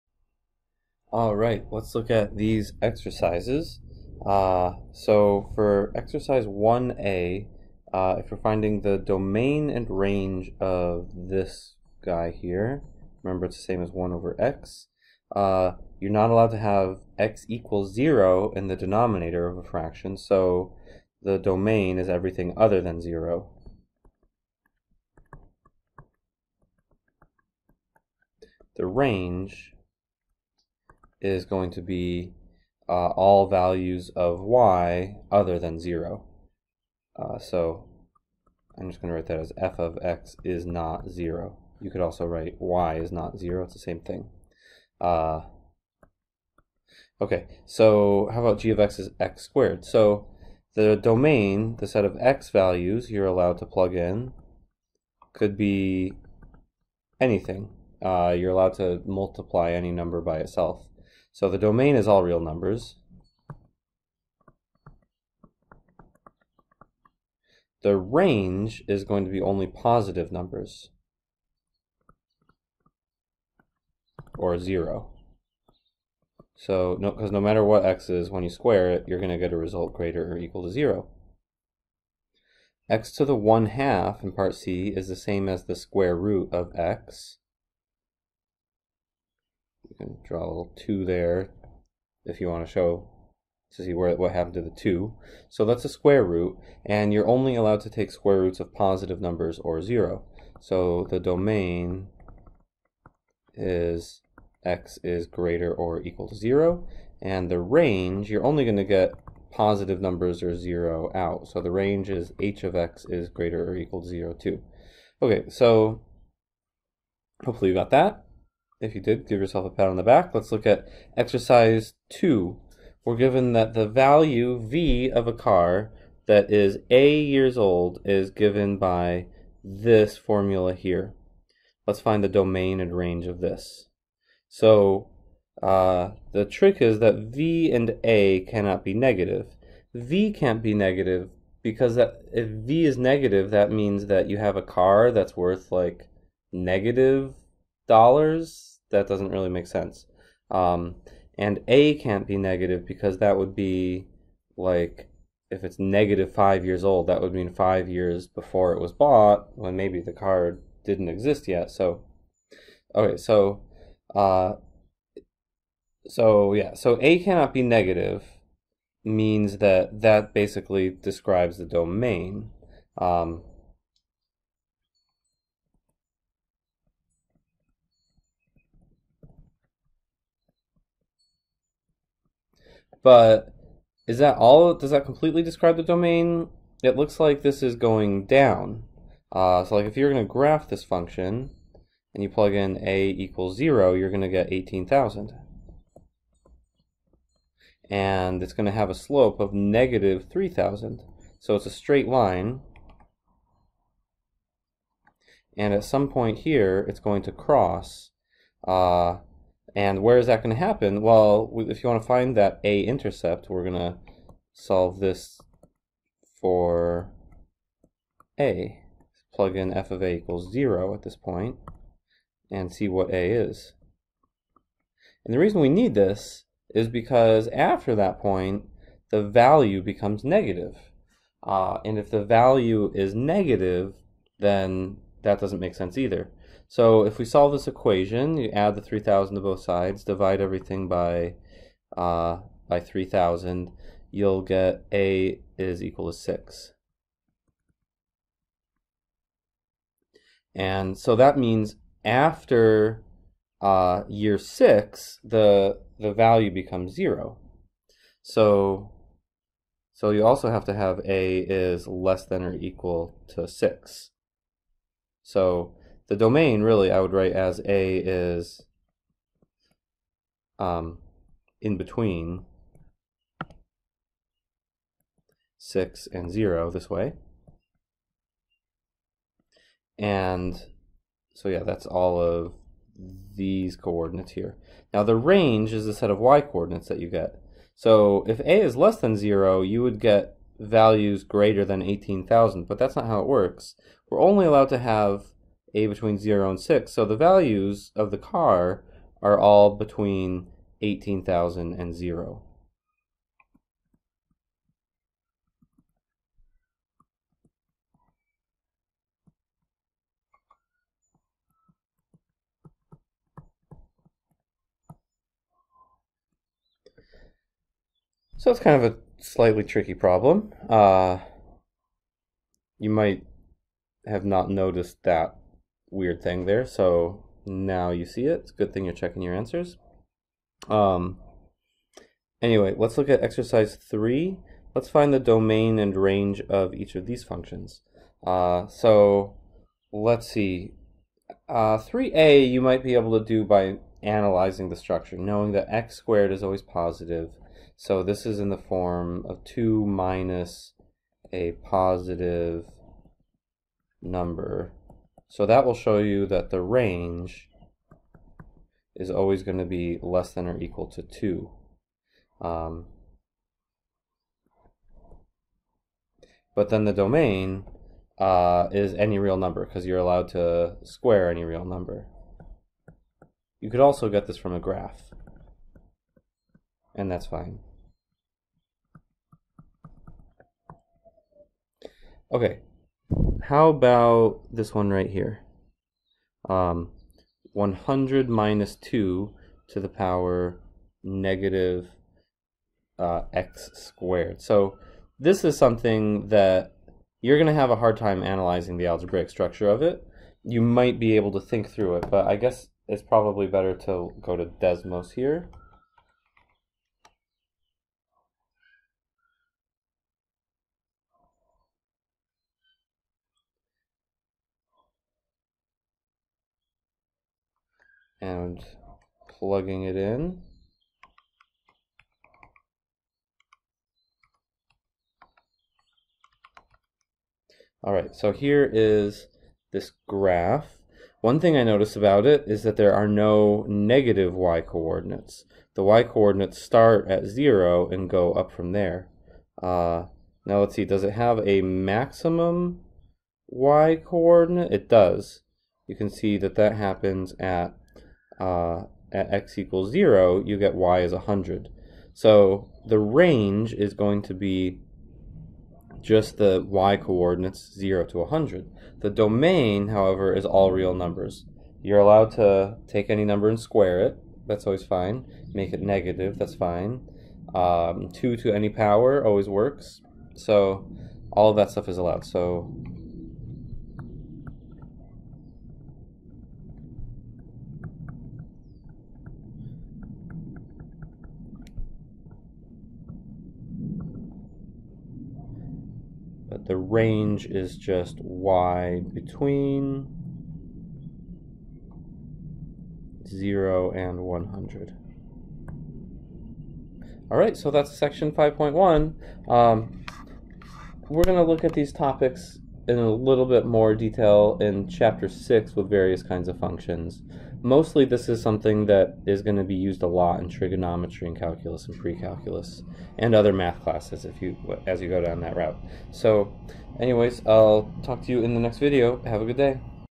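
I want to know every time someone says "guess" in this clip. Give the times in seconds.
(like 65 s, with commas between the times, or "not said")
402 s.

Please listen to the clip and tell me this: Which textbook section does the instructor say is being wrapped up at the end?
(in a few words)
5.1.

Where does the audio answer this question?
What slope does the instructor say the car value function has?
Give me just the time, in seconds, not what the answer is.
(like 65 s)
199 s.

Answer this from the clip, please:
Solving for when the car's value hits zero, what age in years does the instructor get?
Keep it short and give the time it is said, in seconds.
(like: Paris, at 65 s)
6, at 244 s.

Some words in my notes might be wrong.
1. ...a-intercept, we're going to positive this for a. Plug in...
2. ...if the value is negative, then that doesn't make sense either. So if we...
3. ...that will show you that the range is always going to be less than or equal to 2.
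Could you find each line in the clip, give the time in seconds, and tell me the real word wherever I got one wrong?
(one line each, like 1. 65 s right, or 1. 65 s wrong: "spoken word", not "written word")
1. 212 s wrong: "solve", not "positive"
2. 231 s right
3. 355 s right.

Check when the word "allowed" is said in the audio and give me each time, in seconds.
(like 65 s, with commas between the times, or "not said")
16 s, 53 s, 58 s, 97 s, 294 s, 369 s, 461 s, 471 s.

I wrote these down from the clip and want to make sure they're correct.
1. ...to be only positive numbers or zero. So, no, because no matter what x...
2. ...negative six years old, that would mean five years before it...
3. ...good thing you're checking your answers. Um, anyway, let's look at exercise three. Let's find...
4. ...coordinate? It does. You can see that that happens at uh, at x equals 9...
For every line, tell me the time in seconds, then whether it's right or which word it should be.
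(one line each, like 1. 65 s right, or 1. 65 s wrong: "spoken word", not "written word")
1. 69 s right
2. 155 s wrong: "five", not "six"
3. 328 s right
4. 444 s wrong: "0", not "9".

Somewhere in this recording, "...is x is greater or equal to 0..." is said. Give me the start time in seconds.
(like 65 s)
103 s.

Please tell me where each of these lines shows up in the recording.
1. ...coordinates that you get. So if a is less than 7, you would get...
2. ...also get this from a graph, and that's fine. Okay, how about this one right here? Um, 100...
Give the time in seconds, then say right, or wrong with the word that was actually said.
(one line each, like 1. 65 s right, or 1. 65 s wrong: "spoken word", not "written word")
1. 286 s wrong: "0", not "7"
2. 373 s right.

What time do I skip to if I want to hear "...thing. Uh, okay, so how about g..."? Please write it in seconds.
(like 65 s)
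43 s.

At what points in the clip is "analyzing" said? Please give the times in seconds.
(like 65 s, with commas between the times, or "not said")
344 s, 398 s.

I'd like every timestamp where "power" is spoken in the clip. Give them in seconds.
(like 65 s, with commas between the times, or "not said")
389 s, 468 s.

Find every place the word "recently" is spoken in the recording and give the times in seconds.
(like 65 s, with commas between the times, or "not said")
not said.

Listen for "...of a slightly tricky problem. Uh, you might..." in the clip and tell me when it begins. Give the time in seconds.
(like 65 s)
318 s.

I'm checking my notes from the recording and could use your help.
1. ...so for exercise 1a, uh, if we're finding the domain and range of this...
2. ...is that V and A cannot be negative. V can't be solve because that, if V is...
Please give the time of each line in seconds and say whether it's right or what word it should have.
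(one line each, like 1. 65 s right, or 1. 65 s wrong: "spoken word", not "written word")
1. 4 s right
2. 136 s wrong: "negative", not "solve".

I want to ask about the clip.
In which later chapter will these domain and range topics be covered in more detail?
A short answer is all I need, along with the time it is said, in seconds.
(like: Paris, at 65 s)
Chapter 6, at 504 s.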